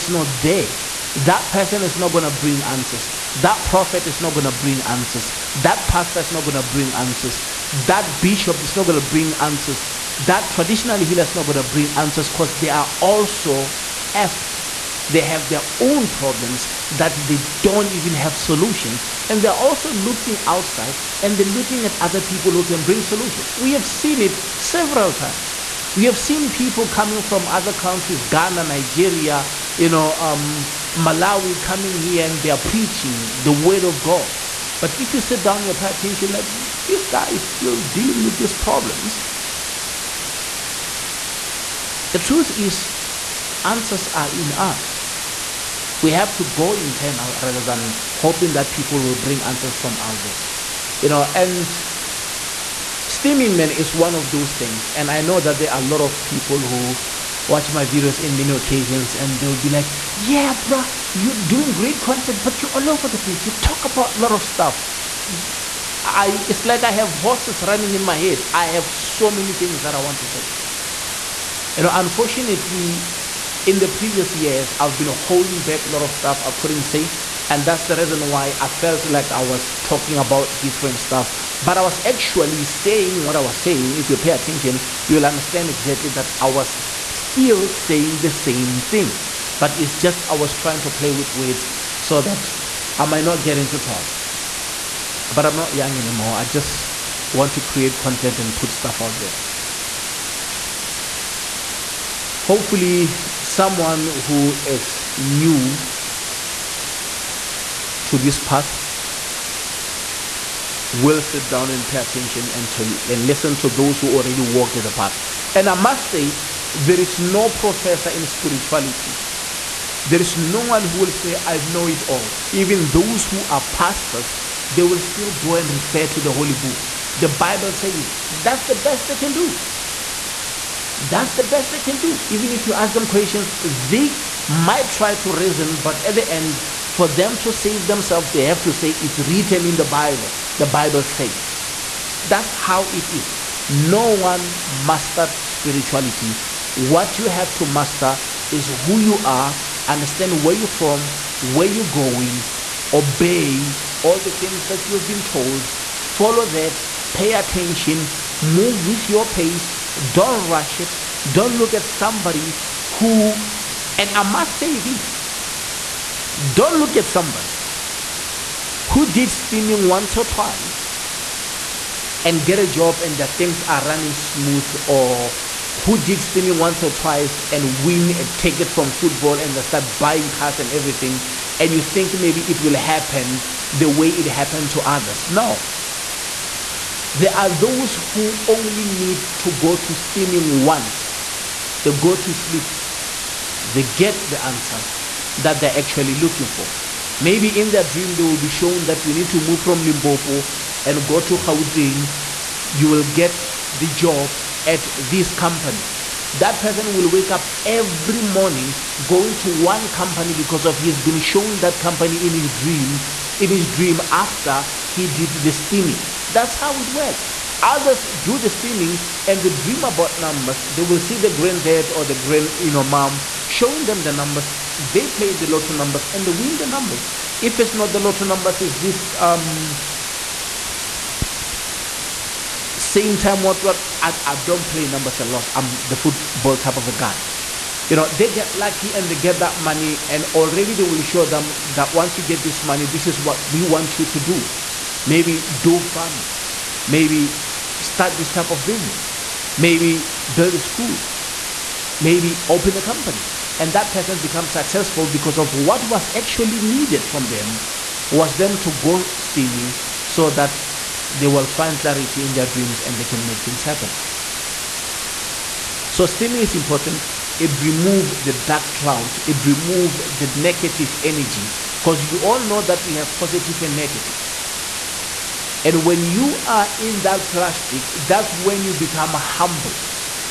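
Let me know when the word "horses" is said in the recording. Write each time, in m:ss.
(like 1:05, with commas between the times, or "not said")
1:07.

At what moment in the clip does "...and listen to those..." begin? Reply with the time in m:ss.
1:53.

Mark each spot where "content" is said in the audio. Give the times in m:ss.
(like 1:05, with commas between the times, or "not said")
1:02, 1:37.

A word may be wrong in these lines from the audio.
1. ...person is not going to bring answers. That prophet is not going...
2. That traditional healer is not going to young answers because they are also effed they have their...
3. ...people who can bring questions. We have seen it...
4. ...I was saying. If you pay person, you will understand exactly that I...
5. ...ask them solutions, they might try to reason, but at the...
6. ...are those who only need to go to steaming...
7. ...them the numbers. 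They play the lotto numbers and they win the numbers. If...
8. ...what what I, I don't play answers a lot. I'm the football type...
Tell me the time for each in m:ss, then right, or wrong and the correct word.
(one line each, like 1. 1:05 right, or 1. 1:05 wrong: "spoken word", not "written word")
1. 0:01 right
2. 0:10 wrong: "bring", not "young"
3. 0:22 wrong: "solutions", not "questions"
4. 1:23 wrong: "attention", not "person"
5. 2:12 wrong: "questions", not "solutions"
6. 3:07 right
7. 3:43 right
8. 3:53 wrong: "numbers", not "answers".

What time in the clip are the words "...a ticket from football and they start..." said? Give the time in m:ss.
2:58.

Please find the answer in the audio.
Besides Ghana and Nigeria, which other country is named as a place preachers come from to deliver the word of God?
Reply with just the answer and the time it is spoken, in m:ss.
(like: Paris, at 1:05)
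Malawi, at 0:30.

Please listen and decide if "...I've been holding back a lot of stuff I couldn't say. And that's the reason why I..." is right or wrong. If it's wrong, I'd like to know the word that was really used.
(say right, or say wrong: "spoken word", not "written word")
right.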